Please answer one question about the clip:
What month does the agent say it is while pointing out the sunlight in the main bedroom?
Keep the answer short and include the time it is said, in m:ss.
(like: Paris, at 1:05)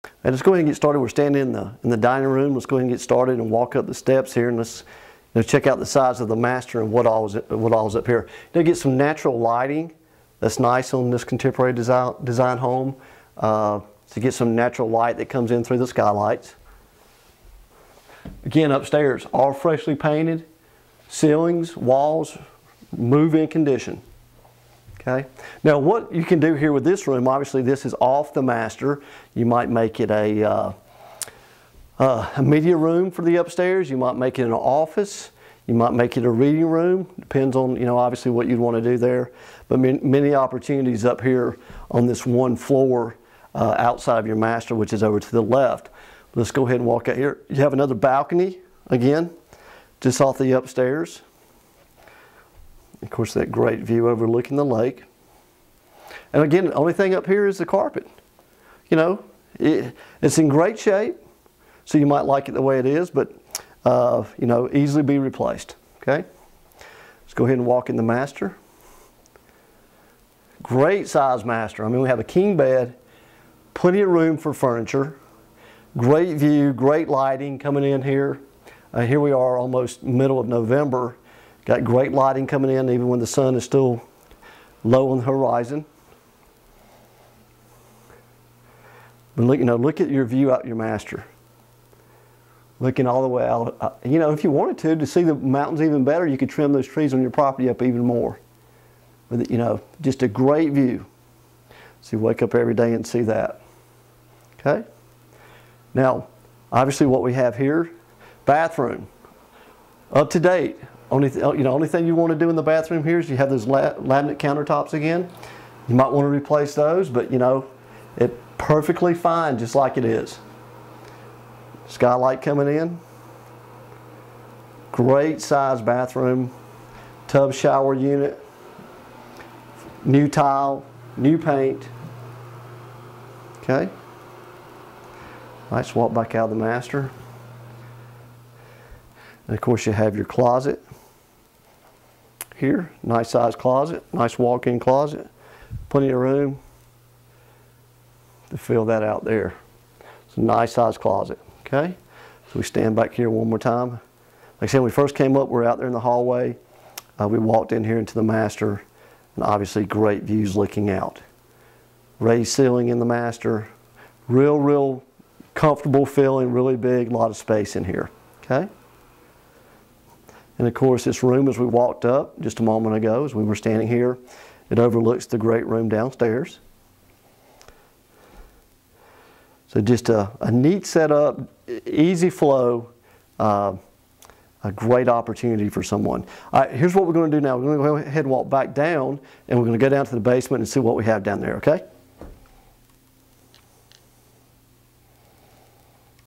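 November, at 1:20.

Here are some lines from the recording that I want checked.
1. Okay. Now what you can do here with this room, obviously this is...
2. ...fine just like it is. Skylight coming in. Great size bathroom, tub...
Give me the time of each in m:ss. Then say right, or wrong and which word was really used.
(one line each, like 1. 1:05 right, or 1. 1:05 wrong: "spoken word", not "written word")
1. 0:25 right
2. 1:59 right.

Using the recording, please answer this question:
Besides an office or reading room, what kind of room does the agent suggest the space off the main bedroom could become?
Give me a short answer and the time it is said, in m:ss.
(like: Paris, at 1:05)
Media room, at 0:32.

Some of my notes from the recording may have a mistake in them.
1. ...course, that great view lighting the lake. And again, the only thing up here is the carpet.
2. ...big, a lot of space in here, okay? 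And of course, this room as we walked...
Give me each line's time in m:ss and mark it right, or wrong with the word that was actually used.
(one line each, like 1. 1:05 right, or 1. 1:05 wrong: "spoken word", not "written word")
1. 0:53 wrong: "overlooking", not "lighting"
2. 2:46 right.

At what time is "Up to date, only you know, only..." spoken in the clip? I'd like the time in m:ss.
1:50.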